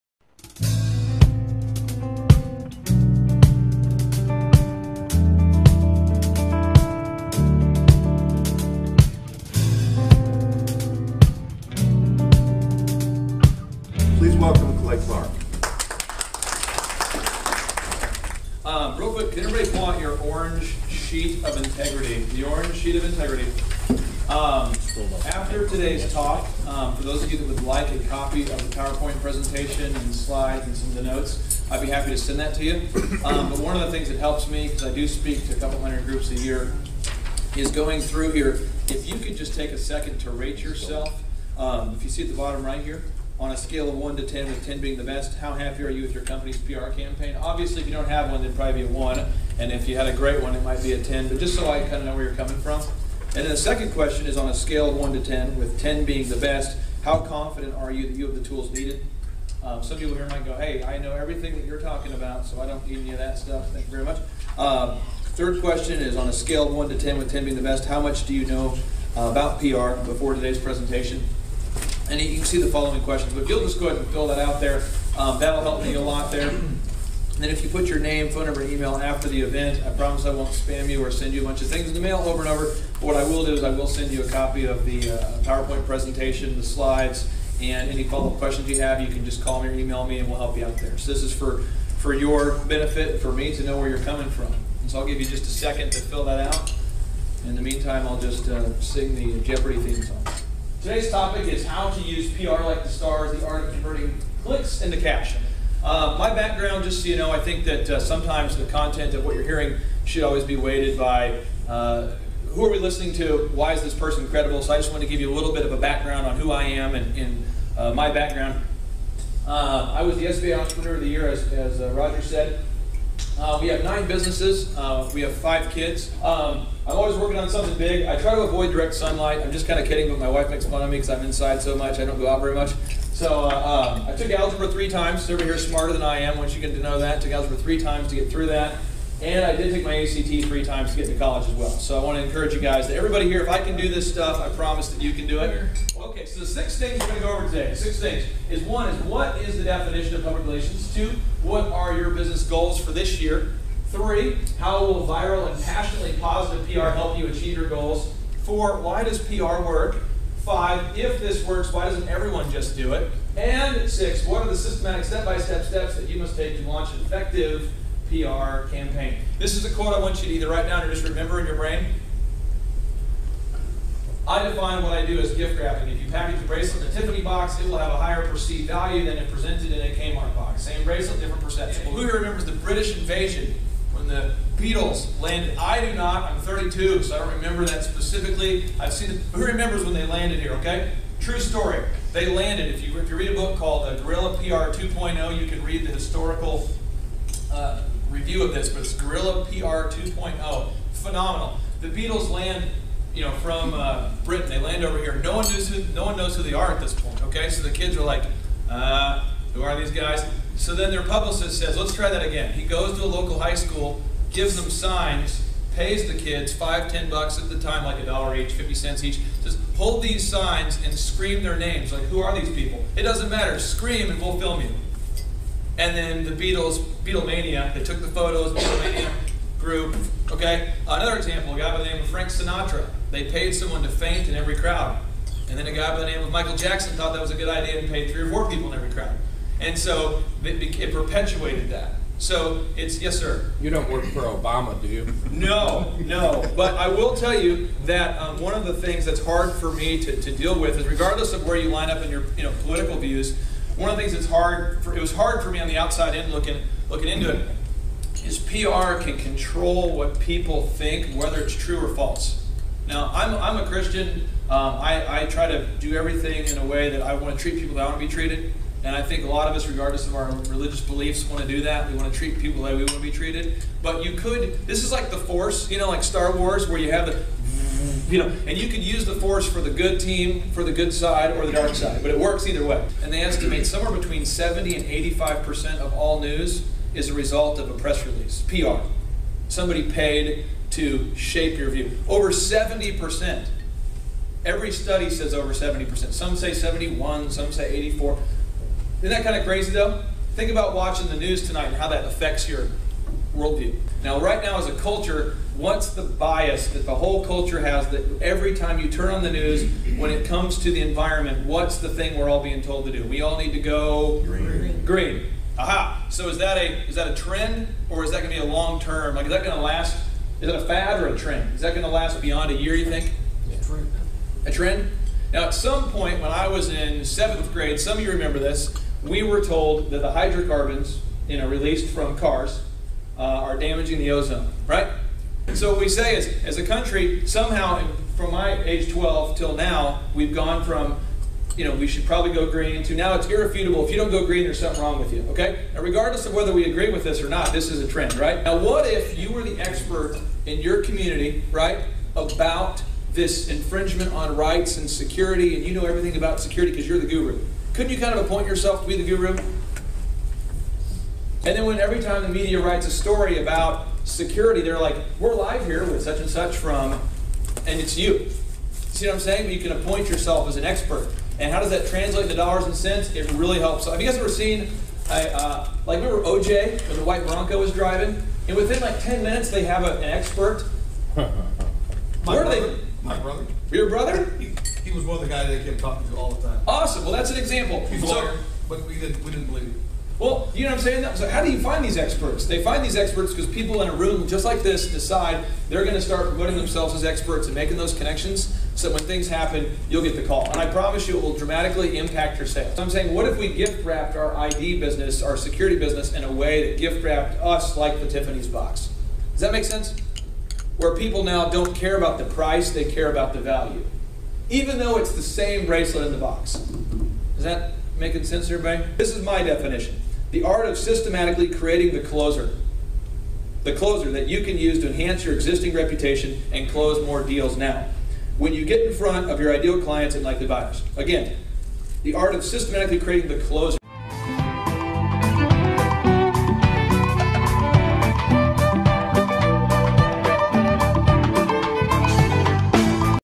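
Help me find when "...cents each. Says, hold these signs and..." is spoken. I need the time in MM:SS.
03:38.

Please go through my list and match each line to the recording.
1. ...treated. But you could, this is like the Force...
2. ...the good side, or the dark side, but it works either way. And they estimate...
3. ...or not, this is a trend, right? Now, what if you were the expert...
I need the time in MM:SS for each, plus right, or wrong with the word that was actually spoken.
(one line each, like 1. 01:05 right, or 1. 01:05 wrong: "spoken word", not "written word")
1. 04:33 right
2. 04:40 right
3. 05:47 right.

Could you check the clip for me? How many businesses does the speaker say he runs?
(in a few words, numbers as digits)
9.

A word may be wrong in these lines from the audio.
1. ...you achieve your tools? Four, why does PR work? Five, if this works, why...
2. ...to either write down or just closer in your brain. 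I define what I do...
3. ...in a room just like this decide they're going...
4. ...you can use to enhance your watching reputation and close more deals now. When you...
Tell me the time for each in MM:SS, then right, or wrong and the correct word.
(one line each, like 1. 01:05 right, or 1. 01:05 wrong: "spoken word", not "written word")
1. 02:37 wrong: "goals", not "tools"
2. 02:50 wrong: "remember", not "closer"
3. 06:33 right
4. 07:04 wrong: "existing", not "watching".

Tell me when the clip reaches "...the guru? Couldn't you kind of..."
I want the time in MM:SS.
05:56.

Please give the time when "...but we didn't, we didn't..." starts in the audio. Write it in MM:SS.
06:28.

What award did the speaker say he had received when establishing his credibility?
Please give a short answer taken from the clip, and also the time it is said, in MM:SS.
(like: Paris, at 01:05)
SBA Entrepreneur of the Year, at 02:00.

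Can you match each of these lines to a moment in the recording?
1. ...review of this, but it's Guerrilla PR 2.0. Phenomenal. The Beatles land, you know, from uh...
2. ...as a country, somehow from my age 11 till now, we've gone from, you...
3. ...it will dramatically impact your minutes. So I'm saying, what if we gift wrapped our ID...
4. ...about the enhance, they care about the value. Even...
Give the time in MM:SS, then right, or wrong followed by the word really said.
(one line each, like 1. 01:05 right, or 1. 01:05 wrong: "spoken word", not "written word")
1. 03:18 right
2. 05:36 wrong: "12", not "11"
3. 06:41 wrong: "sales", not "minutes"
4. 06:51 wrong: "price", not "enhance".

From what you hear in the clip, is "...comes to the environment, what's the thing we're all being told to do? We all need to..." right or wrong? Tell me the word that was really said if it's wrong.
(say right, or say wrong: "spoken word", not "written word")
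right.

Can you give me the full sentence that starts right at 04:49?
Somebody paid to shape your view.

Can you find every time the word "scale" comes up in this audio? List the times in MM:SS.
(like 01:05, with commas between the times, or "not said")
00:43, 00:54, 01:06.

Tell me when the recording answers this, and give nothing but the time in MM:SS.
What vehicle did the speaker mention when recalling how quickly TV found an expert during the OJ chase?
06:17.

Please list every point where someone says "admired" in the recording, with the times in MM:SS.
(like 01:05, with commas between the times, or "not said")
not said.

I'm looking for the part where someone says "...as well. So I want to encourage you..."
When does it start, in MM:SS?
02:21.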